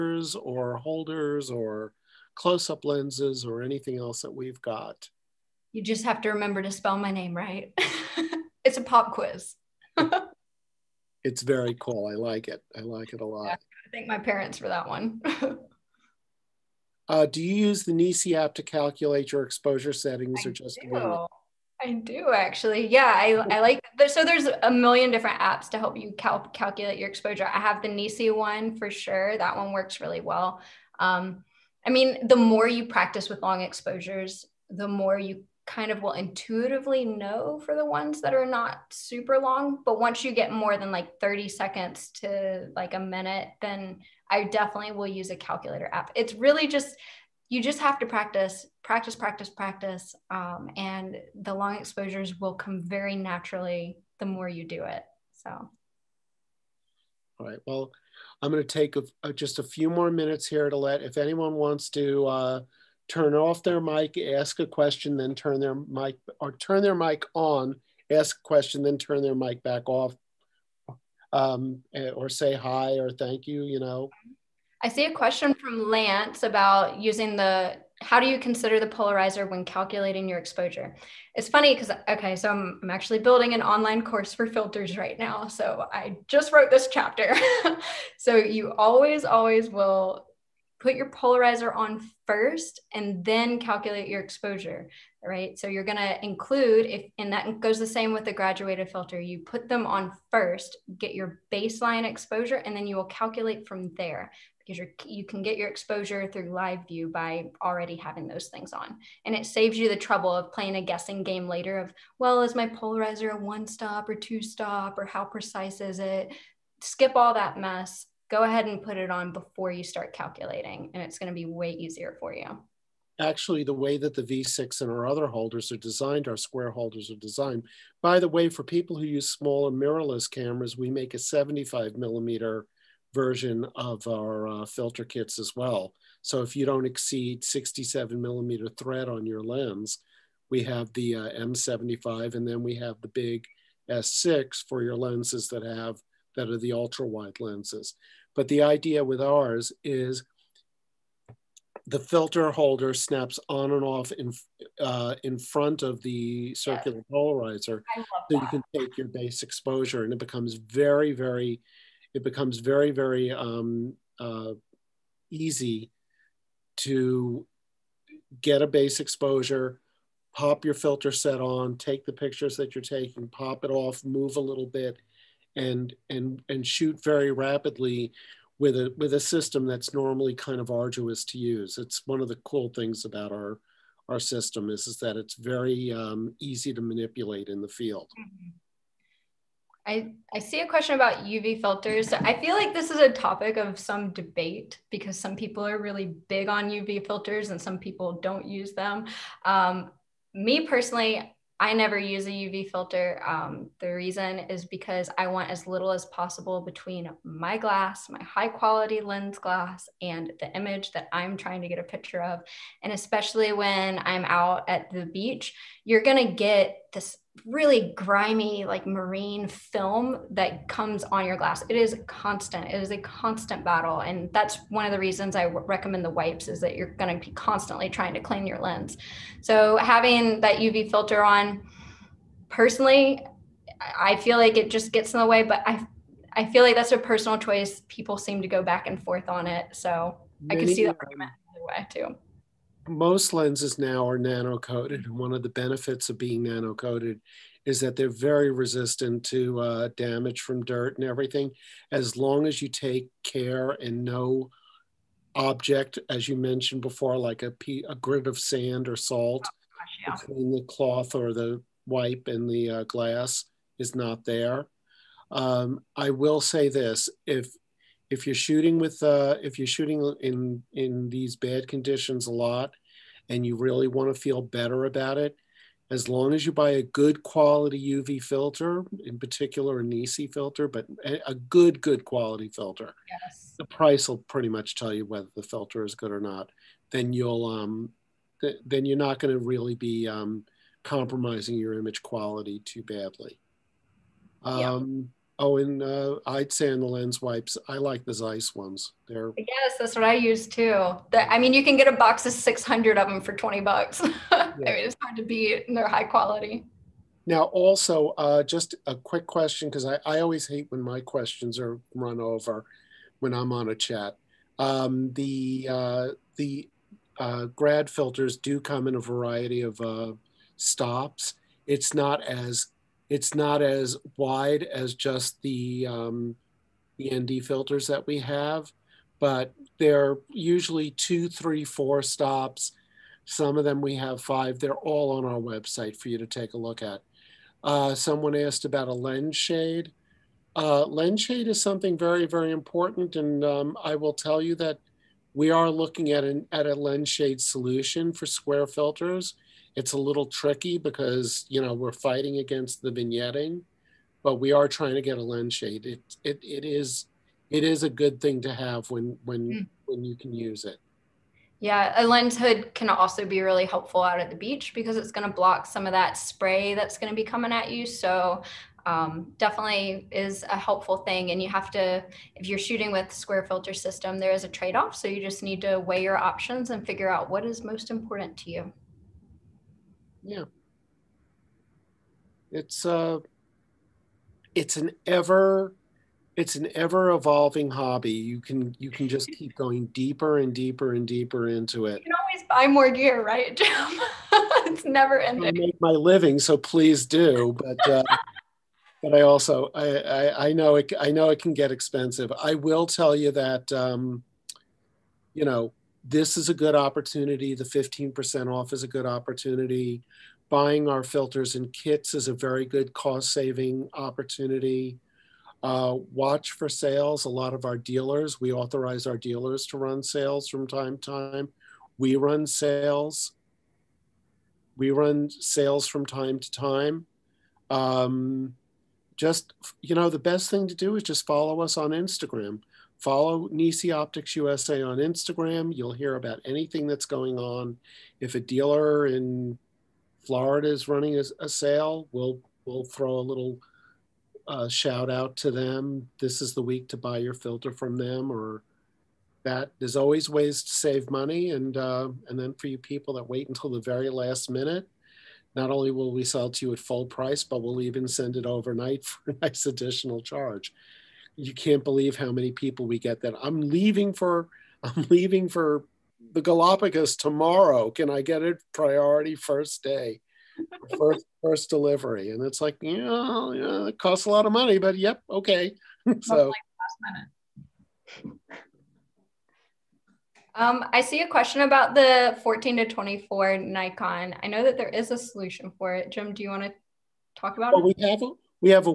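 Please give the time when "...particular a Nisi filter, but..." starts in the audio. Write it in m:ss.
4:39.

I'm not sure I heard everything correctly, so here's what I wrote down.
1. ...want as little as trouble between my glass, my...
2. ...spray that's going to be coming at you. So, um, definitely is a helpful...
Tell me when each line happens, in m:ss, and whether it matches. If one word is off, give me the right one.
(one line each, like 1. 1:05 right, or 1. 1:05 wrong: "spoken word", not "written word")
1. 3:25 wrong: "possible", not "trouble"
2. 6:06 right.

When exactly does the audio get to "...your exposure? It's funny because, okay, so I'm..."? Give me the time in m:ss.
1:20.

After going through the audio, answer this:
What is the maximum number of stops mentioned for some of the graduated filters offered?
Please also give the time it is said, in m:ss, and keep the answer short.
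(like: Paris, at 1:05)
5, at 5:34.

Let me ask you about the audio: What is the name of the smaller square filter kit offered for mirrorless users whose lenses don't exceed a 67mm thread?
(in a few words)
M75.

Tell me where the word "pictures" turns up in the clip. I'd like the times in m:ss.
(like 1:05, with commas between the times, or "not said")
2:52, 3:31.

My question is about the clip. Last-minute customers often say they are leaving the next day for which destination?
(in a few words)
Galapagos.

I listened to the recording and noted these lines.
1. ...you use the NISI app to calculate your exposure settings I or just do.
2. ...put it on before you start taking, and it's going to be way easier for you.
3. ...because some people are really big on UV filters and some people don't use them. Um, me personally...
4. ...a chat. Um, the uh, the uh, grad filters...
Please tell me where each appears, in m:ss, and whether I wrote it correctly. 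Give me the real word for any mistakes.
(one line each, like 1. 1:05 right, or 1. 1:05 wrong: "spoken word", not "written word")
1. 0:17 right
2. 1:58 wrong: "calculating", not "taking"
3. 3:14 right
4. 5:13 right.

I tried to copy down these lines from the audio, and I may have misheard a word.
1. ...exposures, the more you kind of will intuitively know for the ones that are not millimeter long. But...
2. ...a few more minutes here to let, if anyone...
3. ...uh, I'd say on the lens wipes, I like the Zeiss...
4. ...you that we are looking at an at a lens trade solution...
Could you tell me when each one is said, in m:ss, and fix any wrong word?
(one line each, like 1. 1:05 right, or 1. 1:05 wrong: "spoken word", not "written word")
1. 0:33 wrong: "super", not "millimeter"
2. 0:59 right
3. 4:55 right
4. 5:44 wrong: "shade", not "trade".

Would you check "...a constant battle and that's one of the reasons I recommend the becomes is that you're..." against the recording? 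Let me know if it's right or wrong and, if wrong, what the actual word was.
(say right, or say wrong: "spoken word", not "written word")
wrong: "wipes", not "becomes".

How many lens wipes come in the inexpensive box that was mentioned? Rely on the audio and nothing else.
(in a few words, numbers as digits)
600.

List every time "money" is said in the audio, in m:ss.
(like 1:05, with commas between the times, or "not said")
7:31, 7:54.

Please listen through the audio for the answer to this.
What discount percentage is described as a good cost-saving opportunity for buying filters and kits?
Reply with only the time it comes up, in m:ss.
6:47.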